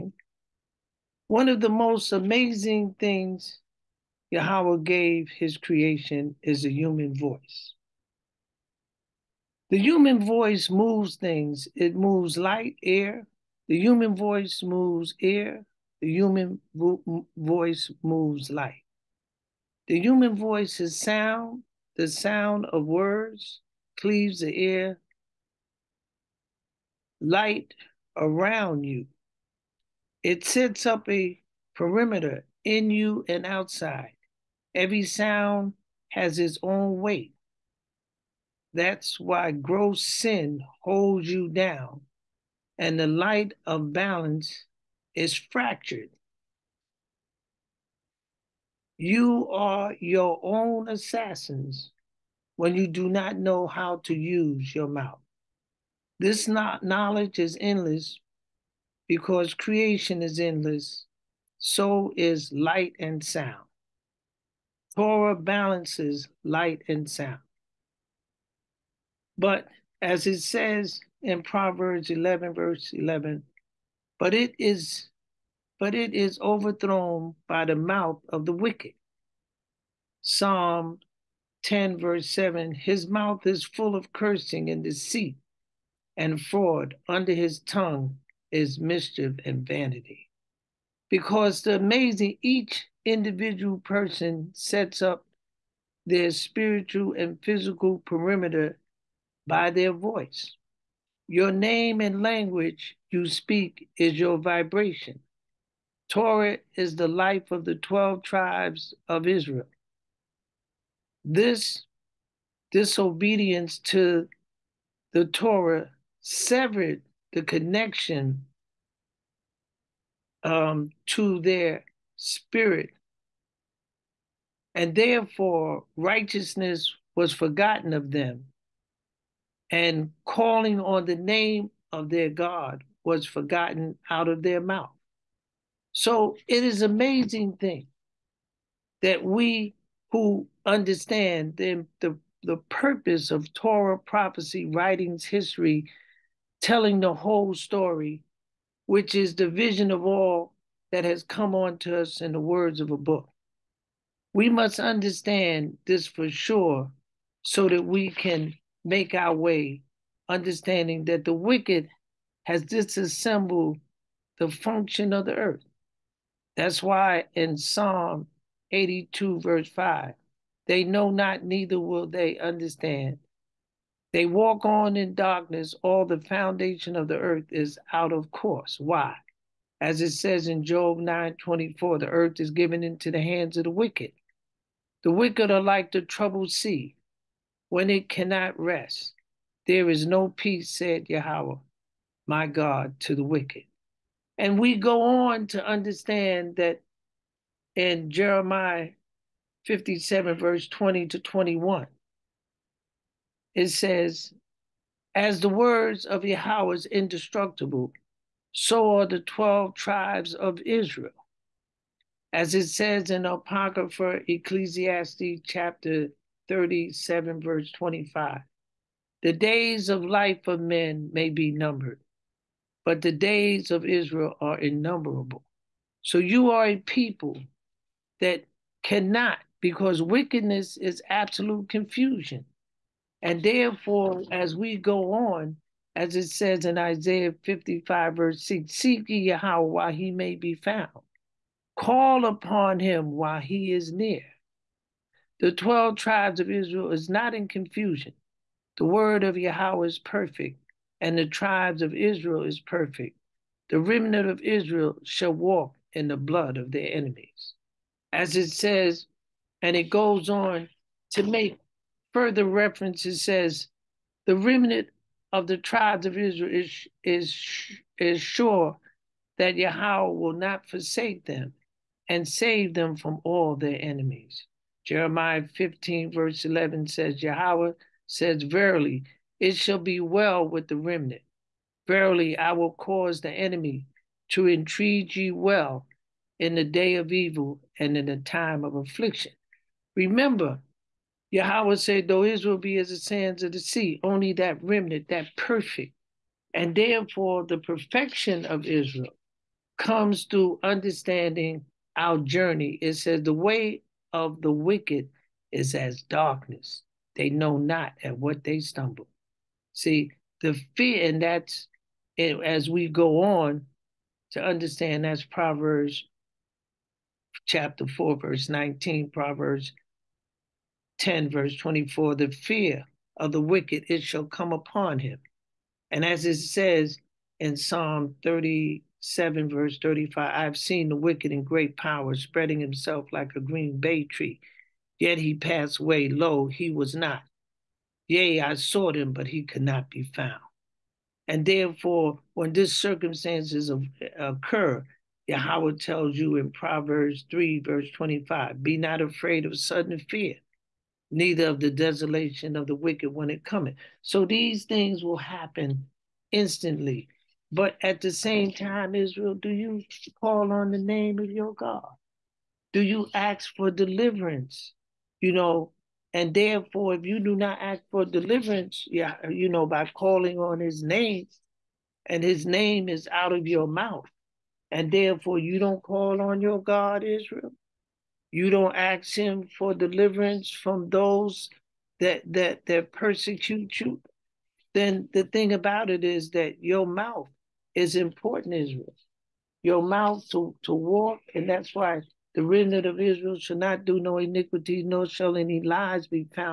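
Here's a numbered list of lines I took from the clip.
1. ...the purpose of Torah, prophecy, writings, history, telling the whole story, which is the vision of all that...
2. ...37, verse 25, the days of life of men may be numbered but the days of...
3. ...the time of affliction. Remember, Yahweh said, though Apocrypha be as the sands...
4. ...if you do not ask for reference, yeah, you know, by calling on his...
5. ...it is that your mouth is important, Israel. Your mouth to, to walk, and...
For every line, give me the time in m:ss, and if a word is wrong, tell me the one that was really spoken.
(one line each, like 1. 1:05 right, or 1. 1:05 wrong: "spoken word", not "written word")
1. 2:22 right
2. 3:36 right
3. 4:48 wrong: "Israel", not "Apocrypha"
4. 6:06 wrong: "deliverance", not "reference"
5. 6:25 right.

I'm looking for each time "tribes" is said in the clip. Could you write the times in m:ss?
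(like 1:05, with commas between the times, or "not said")
1:48, 3:29, 4:05, 4:11, 4:25.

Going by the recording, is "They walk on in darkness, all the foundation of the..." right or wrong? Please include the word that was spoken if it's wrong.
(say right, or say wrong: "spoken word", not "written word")
right.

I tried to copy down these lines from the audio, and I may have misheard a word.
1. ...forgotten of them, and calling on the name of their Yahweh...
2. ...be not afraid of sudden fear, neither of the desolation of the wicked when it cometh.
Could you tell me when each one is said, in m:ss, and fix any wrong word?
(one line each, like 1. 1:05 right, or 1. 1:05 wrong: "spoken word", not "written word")
1. 2:07 wrong: "God", not "Yahweh"
2. 5:48 right.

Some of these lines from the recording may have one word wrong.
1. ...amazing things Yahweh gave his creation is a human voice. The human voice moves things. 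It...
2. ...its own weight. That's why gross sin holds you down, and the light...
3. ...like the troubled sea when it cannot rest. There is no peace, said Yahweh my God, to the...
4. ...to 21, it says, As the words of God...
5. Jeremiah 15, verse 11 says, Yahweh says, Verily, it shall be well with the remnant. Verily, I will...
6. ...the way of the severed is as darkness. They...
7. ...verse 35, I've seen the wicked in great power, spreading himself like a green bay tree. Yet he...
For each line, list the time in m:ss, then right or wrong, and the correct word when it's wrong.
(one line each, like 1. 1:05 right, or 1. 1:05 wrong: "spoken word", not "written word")
1. 0:02 right
2. 0:36 right
3. 3:05 right
4. 3:21 wrong: "Yahweh", not "God"
5. 4:34 right
6. 5:03 wrong: "wicked", not "severed"
7. 5:29 right.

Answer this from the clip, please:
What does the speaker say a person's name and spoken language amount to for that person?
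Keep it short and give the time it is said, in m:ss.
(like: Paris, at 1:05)
Your vibration, at 1:44.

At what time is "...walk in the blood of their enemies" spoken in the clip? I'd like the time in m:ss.
4:15.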